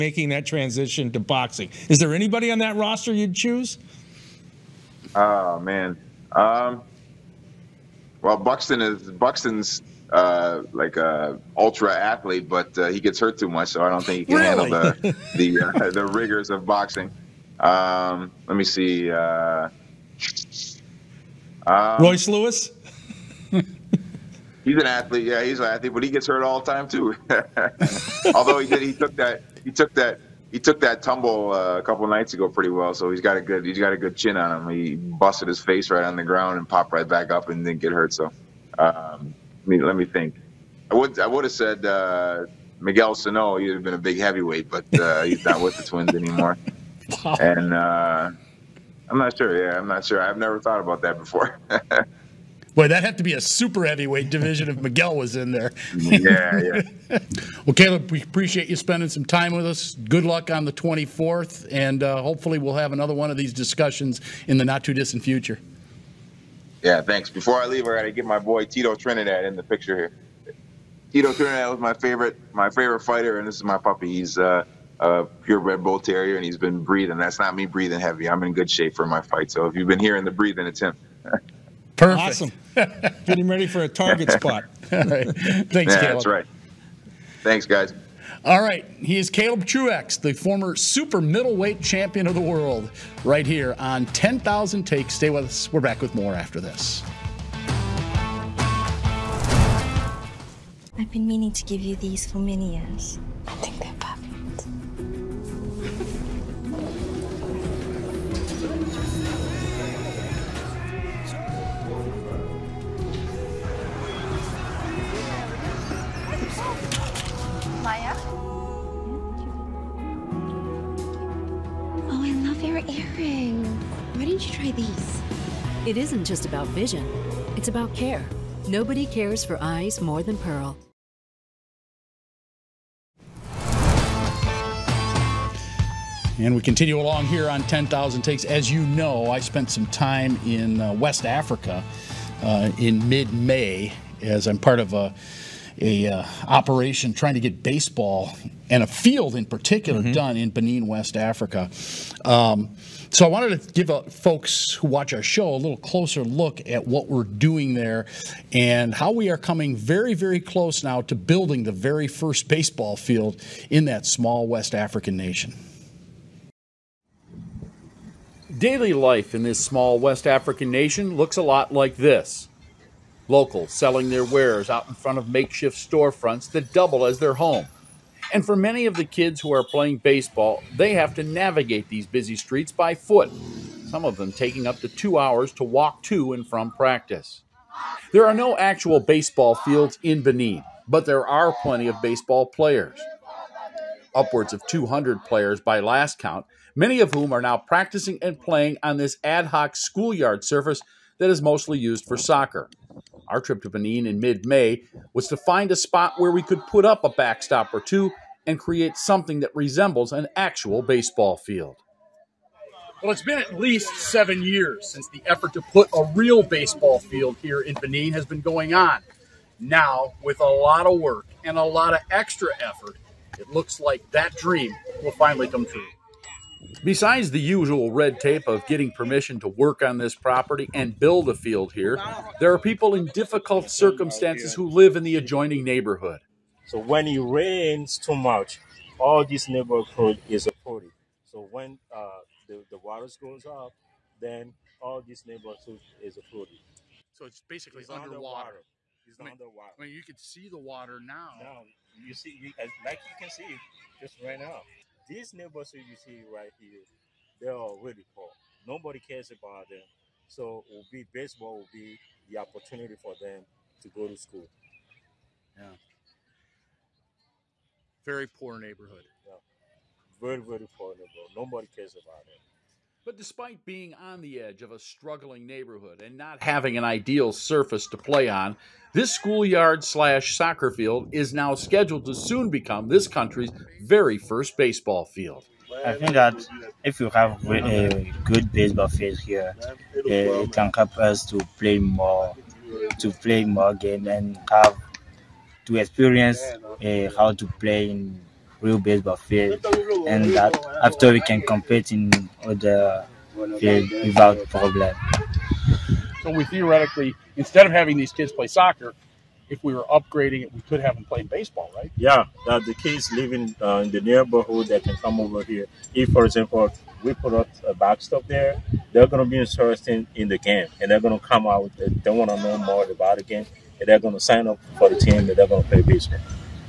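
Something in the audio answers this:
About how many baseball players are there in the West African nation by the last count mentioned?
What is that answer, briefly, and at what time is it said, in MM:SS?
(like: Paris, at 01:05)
200, at 03:14.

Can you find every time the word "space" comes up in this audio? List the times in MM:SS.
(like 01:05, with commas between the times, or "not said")
not said.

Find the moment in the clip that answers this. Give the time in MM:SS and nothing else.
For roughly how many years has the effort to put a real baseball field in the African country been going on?
03:33.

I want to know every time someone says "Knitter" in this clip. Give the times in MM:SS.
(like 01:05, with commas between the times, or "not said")
not said.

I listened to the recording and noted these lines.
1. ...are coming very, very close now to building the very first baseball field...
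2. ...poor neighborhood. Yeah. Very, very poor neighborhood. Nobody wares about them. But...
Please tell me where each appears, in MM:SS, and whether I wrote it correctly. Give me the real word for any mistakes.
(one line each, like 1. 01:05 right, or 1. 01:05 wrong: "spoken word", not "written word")
1. 02:39 right
2. 04:28 wrong: "cares", not "wares".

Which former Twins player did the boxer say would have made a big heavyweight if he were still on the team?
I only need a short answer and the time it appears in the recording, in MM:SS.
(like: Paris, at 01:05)
Miguel Sano, at 00:42.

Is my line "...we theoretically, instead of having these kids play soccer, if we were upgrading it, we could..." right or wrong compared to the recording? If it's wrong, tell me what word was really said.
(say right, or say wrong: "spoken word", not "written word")
right.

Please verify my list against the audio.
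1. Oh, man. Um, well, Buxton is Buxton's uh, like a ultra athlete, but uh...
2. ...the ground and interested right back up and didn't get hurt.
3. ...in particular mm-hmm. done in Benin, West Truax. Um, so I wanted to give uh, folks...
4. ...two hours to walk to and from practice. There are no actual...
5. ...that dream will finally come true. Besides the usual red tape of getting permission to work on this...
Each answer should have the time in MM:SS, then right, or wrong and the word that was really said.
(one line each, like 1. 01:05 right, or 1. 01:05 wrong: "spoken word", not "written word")
1. 00:05 right
2. 00:36 wrong: "popped", not "interested"
3. 02:29 wrong: "Africa", not "Truax"
4. 03:04 right
5. 03:44 right.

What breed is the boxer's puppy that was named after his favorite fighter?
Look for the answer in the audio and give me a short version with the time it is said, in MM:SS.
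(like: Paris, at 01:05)
Bull terrier, at 01:15.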